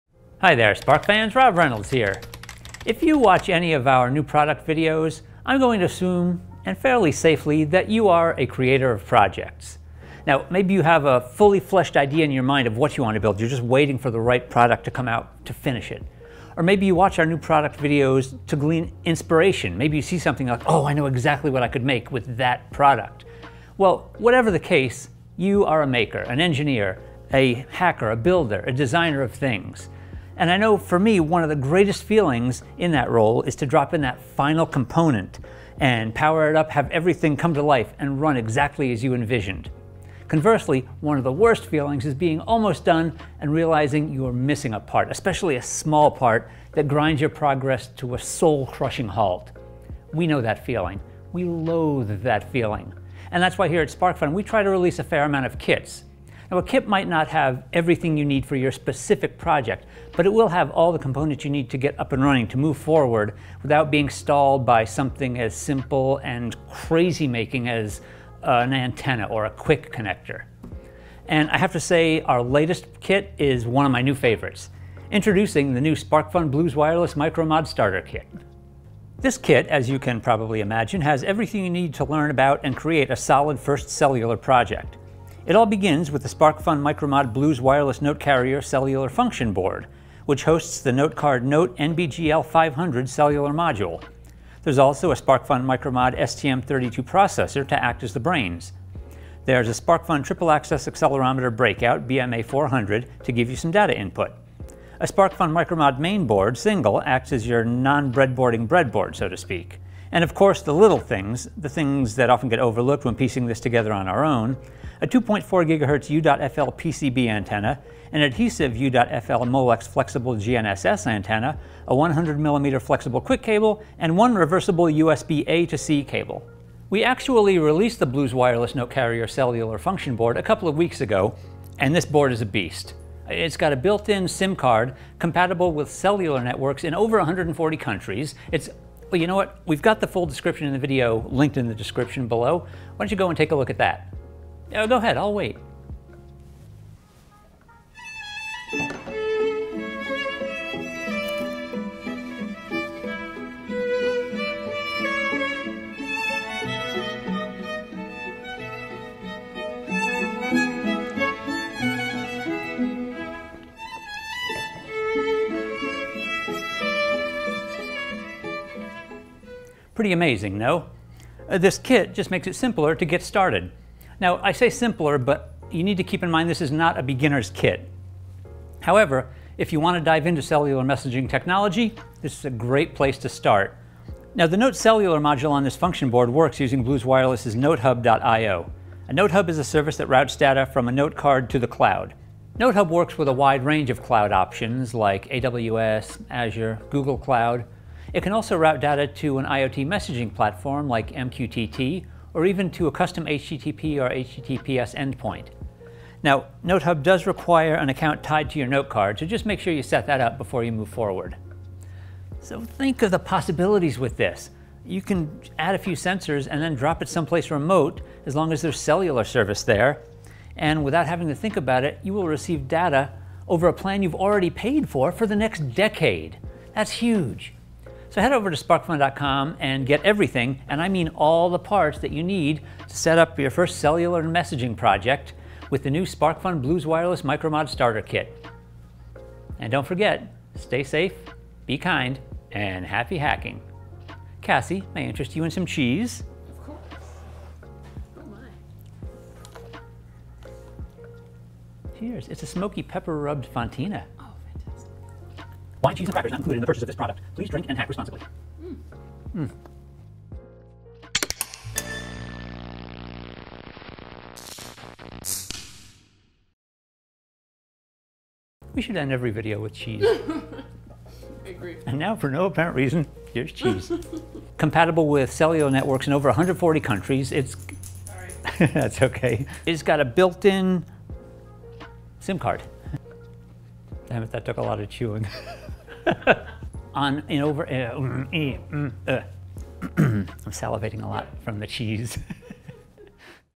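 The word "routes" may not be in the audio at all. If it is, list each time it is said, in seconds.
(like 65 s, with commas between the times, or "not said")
190 s, 198 s.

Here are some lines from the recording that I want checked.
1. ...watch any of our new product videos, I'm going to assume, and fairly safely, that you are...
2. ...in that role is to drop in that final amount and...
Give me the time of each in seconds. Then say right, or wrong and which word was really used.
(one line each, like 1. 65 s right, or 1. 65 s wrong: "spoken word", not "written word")
1. 3 s right
2. 32 s wrong: "component", not "amount".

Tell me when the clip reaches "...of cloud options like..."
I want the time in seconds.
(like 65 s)
193 s.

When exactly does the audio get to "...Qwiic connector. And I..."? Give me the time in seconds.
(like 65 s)
69 s.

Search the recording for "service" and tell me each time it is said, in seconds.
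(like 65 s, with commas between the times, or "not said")
189 s, 219 s.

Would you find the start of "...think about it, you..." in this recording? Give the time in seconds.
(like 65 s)
221 s.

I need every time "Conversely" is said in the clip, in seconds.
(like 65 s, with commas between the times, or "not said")
40 s.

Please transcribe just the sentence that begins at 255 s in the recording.
Why cheese and crackers not included in the purchase of this product?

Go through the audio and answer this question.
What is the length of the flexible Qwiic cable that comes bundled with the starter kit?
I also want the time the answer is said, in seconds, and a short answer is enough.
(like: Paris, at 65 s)
100 mm, at 121 s.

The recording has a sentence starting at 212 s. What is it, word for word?
So think of the possibilities with this.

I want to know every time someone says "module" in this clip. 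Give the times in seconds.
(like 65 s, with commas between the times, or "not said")
93 s, 185 s.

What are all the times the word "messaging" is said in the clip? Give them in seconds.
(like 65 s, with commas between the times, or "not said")
180 s, 199 s, 234 s.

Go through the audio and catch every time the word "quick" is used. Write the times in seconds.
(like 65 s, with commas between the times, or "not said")
not said.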